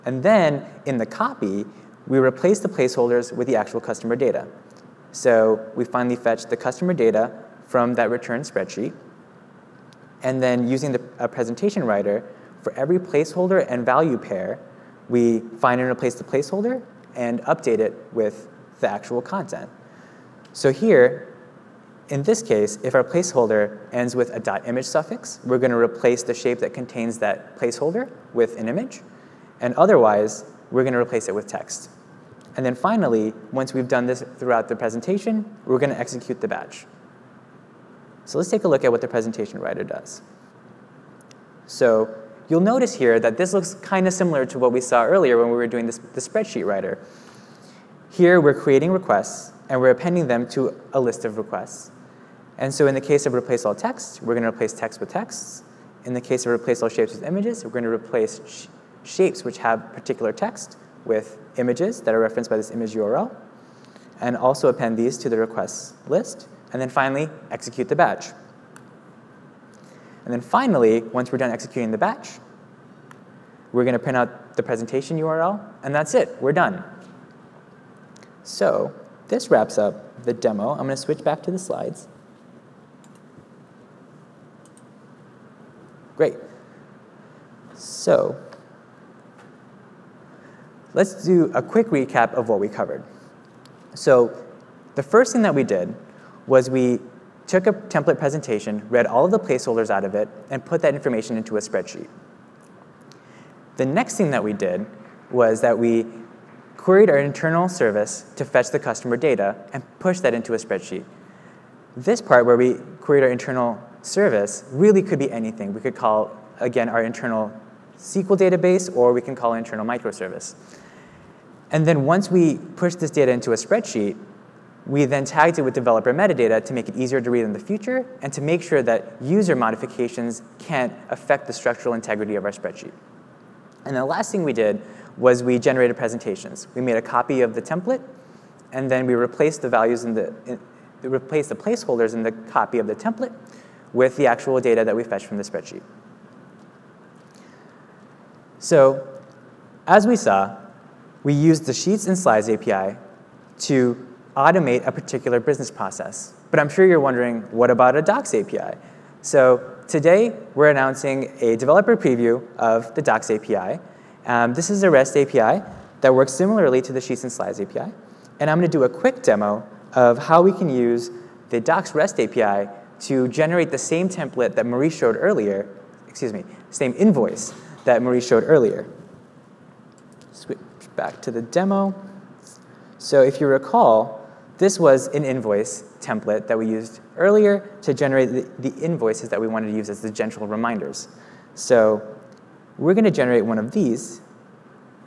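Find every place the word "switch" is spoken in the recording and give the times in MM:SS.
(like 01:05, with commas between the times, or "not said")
01:20, 03:00.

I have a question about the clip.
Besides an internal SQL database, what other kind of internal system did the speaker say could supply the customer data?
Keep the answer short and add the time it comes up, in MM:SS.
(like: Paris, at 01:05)
microservice, at 01:59.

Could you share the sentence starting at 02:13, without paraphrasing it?
And the last thing we did was we generated presentations.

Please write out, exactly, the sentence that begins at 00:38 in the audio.
So let's take a look at what the presentation writer does.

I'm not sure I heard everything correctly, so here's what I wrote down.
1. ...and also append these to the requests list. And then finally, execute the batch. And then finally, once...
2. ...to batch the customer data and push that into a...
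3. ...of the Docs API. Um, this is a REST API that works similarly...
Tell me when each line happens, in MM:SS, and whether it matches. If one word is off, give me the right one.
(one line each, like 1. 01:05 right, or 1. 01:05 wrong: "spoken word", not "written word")
1. 01:04 right
2. 01:48 wrong: "fetch", not "batch"
3. 02:42 right.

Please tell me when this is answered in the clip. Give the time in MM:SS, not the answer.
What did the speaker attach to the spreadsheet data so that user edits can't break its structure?
02:05.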